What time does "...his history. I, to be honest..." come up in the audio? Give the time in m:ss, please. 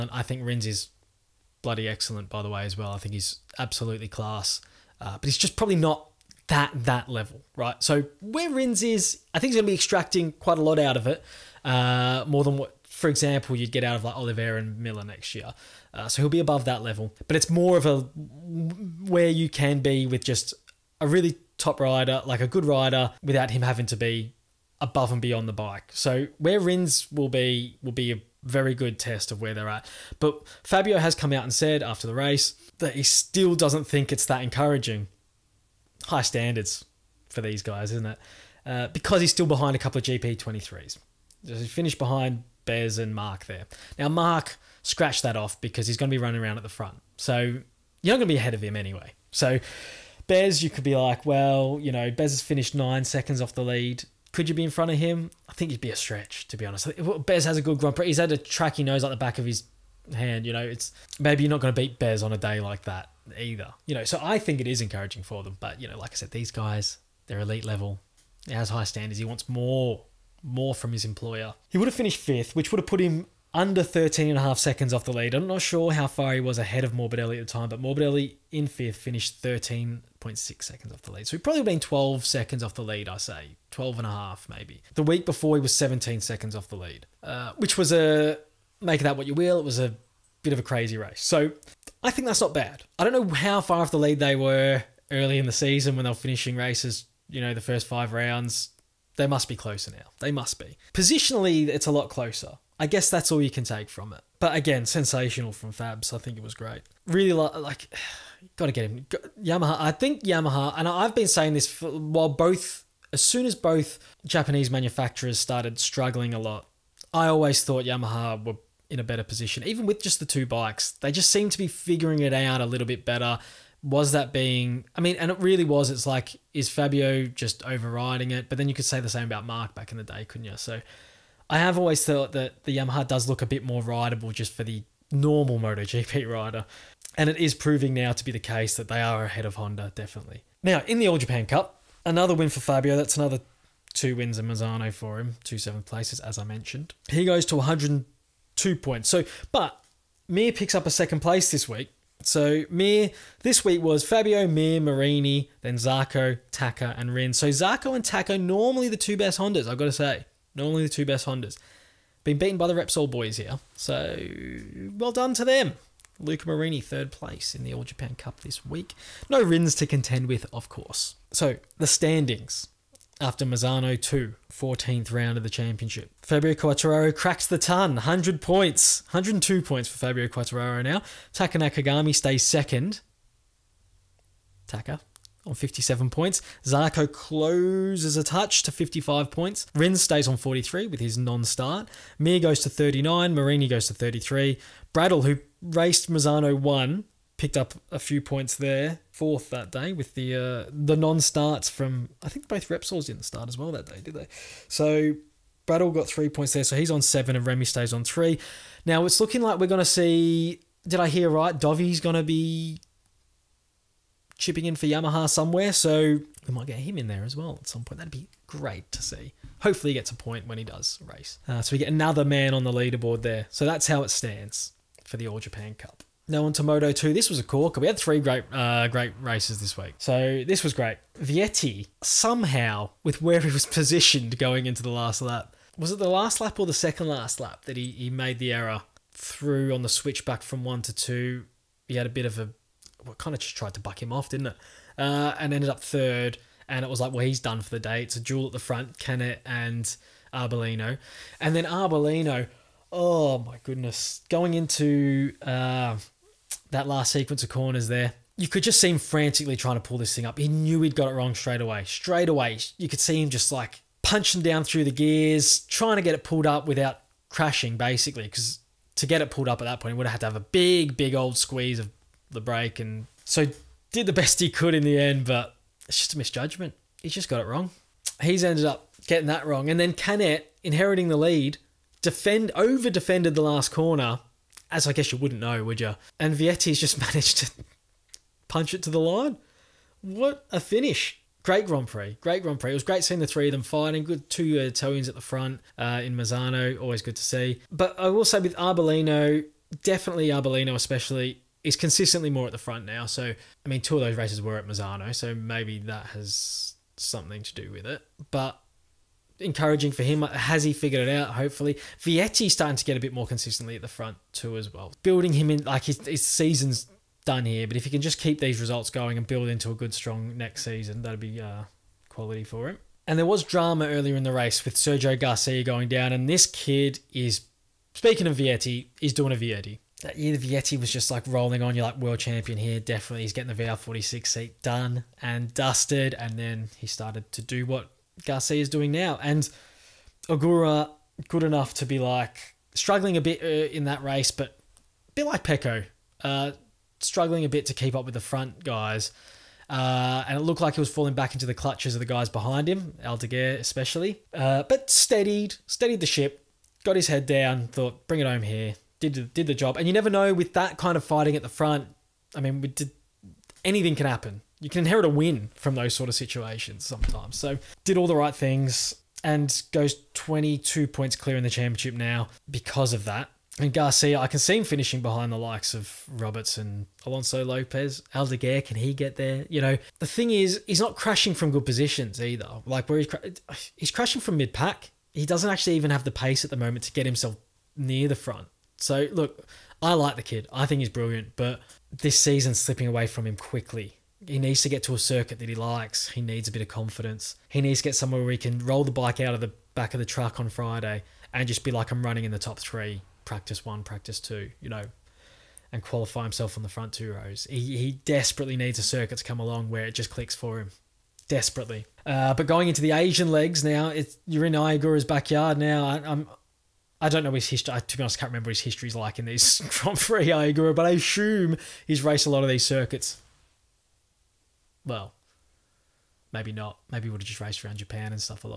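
6:57.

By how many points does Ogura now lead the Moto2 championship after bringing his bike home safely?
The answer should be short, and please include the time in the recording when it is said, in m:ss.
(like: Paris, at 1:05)
22, at 6:10.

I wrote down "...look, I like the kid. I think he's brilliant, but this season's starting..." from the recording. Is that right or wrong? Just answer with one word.
wrong.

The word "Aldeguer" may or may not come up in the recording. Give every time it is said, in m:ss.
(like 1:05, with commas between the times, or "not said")
5:53, 6:18.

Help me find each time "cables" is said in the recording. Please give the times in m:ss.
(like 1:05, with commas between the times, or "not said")
not said.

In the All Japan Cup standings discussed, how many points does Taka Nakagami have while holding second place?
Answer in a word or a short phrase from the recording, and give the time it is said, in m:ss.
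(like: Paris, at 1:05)
57, at 3:05.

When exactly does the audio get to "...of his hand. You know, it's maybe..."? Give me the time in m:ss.
0:59.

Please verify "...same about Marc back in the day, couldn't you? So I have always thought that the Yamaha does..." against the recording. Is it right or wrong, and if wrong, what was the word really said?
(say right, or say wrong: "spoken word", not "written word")
right.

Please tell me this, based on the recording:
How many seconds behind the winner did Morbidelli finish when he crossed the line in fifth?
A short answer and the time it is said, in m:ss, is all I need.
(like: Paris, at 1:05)
13.6 seconds, at 1:19.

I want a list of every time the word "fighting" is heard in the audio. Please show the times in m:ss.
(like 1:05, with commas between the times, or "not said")
4:53, 6:01.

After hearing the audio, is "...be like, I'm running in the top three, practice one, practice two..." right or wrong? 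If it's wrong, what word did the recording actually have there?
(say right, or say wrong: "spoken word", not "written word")
right.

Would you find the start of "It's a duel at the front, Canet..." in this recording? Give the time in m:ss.
4:08.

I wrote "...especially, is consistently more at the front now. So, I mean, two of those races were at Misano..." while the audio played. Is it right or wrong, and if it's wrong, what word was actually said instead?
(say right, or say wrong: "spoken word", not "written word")
right.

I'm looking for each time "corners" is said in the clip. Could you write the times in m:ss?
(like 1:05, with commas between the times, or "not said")
4:17, 4:43.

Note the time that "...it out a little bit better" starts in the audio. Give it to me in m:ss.
2:02.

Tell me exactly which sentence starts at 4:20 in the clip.
He knew he'd got it wrong straight away.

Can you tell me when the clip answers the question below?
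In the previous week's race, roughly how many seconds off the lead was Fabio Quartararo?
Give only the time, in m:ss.
1:25.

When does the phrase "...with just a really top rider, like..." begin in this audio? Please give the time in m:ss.
0:20.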